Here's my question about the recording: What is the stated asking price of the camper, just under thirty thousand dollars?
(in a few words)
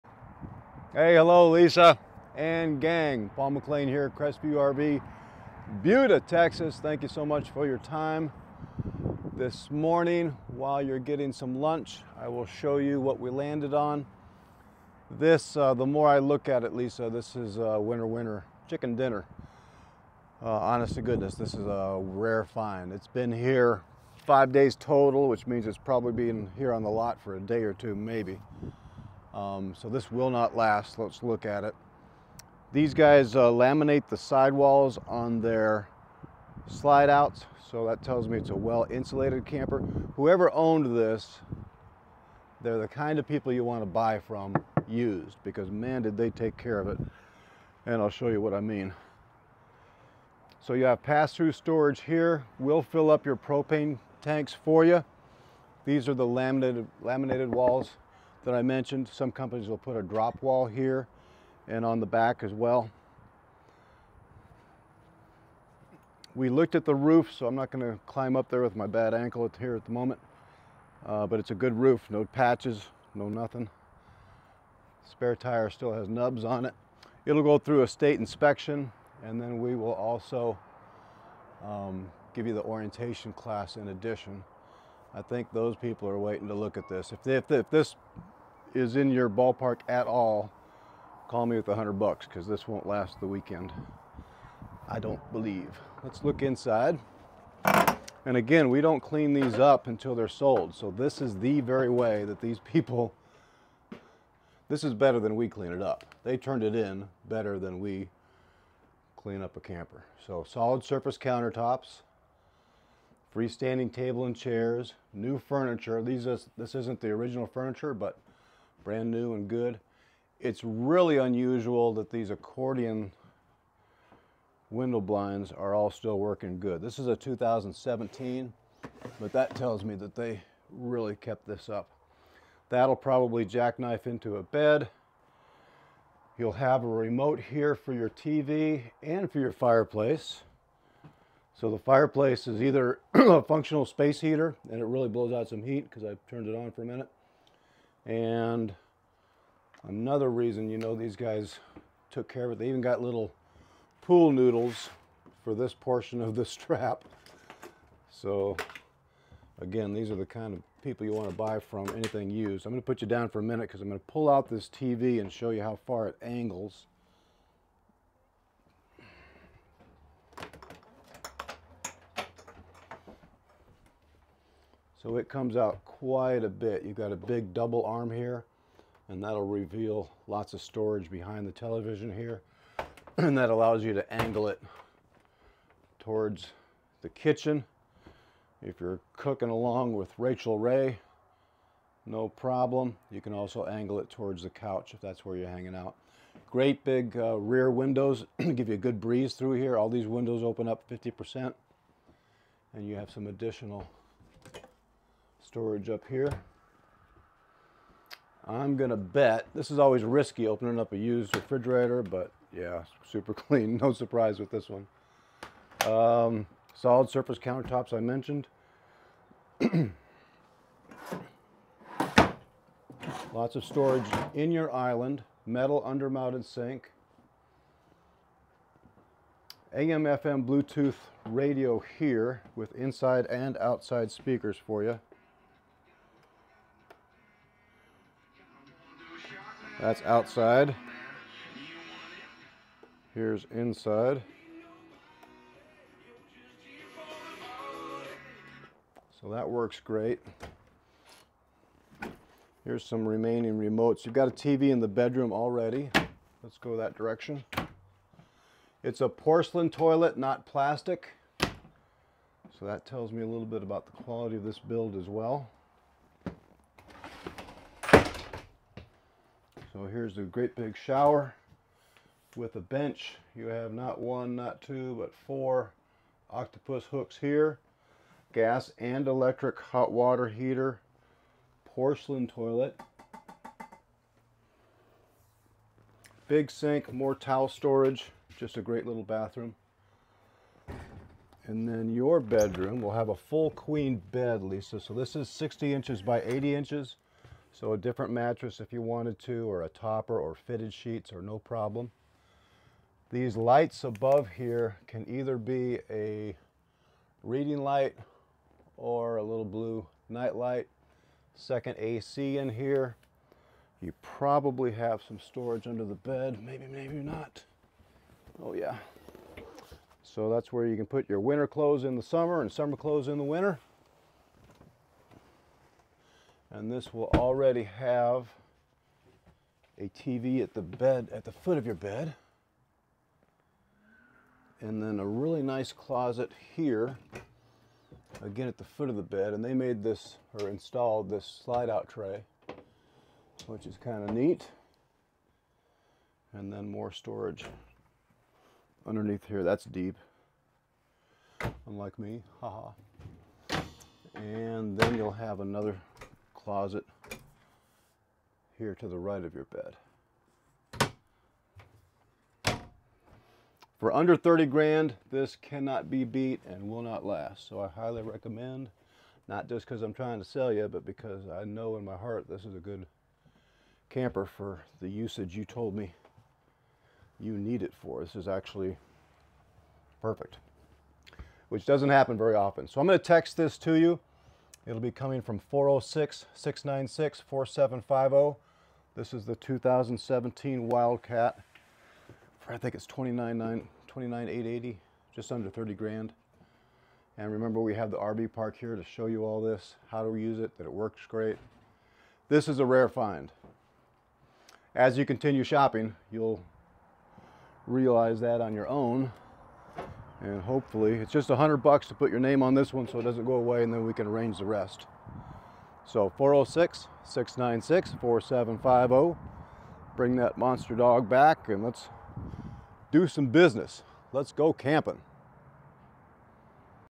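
$29,880.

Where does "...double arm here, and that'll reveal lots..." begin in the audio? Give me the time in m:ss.
2:57.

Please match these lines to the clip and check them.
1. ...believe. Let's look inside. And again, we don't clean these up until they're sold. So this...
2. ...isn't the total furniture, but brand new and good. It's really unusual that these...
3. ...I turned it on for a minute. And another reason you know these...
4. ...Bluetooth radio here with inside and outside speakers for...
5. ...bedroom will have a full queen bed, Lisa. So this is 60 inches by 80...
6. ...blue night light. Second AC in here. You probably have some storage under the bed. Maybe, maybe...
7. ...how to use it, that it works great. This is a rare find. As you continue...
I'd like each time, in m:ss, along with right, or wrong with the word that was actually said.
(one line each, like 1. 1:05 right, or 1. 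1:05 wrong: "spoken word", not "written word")
1. 1:35 right
2. 1:56 wrong: "original", not "total"
3. 2:26 right
4. 3:50 right
5. 4:52 right
6. 5:09 right
7. 6:39 right.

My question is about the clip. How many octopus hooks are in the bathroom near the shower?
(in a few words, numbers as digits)
4.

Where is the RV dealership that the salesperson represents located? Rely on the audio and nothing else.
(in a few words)
Buda, Texas.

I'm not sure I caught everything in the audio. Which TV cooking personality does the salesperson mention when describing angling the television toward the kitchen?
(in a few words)
Rachel Ray.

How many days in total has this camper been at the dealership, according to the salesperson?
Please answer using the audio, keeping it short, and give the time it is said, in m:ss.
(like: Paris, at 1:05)
5, at 0:24.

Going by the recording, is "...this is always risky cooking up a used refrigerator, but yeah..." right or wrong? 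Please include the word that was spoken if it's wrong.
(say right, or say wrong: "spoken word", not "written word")
wrong: "opening", not "cooking".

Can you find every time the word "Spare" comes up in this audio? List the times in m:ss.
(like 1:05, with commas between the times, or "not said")
1:15.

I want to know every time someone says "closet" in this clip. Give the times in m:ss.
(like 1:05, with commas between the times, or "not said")
5:35, 5:56.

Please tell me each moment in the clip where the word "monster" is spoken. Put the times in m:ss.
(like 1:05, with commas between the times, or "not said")
7:00.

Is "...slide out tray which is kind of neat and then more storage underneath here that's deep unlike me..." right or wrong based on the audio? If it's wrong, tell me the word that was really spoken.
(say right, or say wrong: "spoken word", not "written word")
right.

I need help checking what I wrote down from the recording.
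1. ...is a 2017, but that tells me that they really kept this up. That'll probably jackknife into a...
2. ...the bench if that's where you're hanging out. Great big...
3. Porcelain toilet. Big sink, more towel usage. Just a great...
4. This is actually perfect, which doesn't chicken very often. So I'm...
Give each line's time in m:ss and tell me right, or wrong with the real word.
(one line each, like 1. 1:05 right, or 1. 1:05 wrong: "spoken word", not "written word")
1. 2:06 right
2. 3:14 wrong: "couch", not "bench"
3. 4:41 wrong: "storage", not "usage"
4. 6:18 wrong: "happen", not "chicken".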